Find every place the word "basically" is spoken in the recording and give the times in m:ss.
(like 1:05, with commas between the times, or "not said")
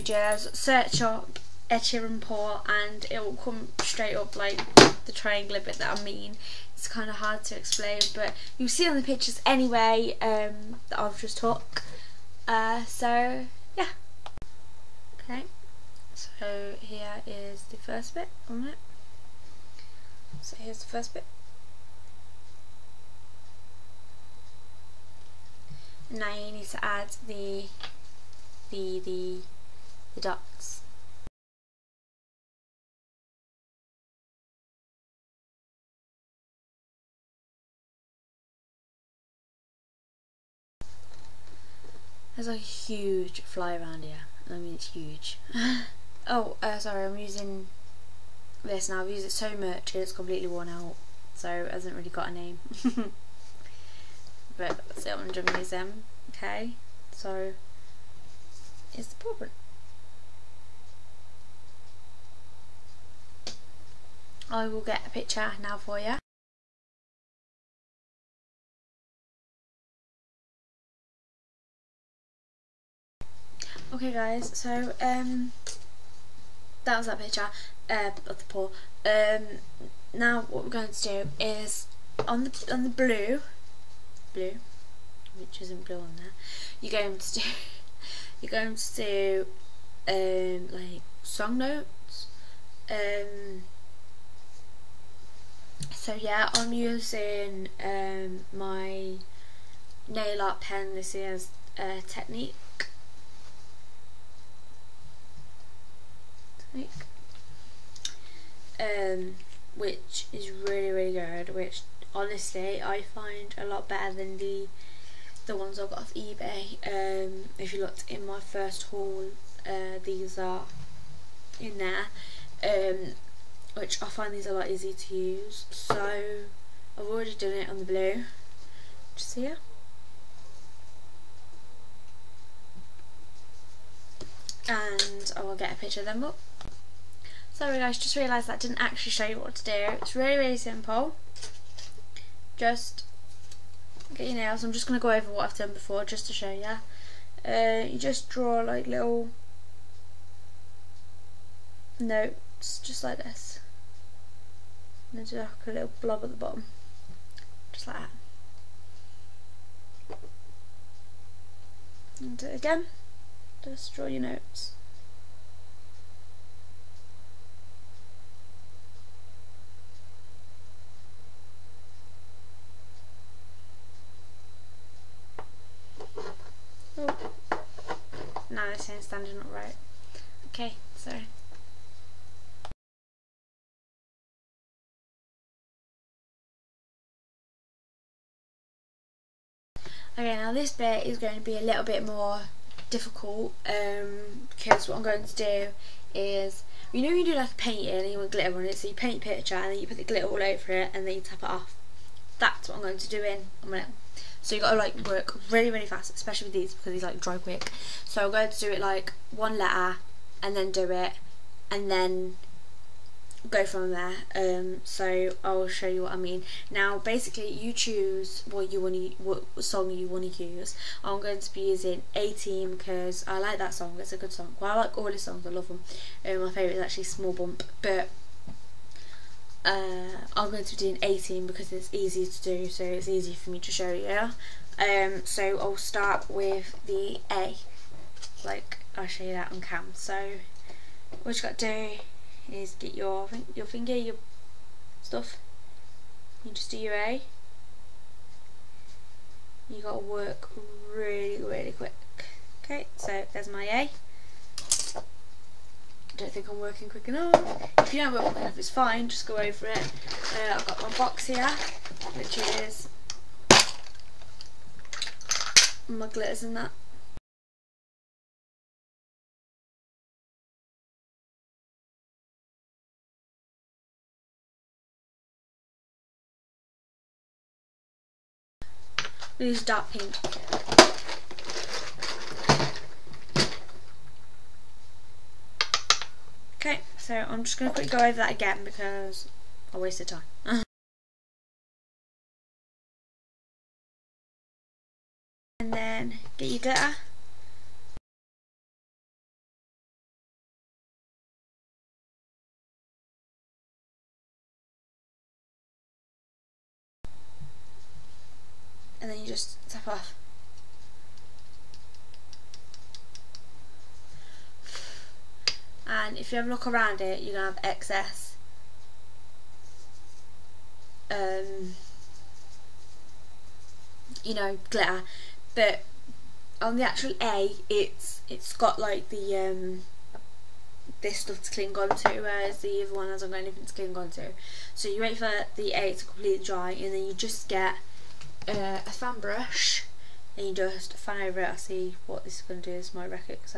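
3:36.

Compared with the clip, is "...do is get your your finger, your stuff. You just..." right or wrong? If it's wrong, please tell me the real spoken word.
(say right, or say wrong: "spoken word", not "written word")
right.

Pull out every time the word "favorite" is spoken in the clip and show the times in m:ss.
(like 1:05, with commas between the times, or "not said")
3:46.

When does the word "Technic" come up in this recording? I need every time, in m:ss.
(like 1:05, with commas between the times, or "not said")
1:42, 1:46.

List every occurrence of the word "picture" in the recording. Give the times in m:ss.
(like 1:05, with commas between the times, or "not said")
0:09, 1:05, 1:17, 2:15, 3:19.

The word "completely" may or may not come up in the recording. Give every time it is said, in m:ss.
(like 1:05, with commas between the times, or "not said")
0:50, 5:36.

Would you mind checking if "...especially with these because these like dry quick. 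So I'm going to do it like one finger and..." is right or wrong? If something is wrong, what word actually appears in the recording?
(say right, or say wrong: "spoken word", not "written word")
wrong: "letter", not "finger".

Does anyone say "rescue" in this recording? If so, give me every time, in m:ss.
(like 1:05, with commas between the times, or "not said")
not said.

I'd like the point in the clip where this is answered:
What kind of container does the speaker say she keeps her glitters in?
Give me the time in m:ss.
4:20.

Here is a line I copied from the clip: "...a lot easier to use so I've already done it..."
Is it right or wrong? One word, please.
right.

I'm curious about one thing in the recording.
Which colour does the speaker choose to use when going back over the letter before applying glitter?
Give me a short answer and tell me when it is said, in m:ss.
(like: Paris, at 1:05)
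Dark pink, at 4:39.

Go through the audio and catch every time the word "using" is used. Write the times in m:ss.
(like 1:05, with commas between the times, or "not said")
0:47, 1:36, 3:41.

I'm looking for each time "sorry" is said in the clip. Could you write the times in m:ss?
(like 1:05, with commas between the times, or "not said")
0:46, 2:17, 3:00.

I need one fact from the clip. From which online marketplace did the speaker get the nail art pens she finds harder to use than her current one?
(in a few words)
eBay.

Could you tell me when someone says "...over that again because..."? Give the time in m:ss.
4:48.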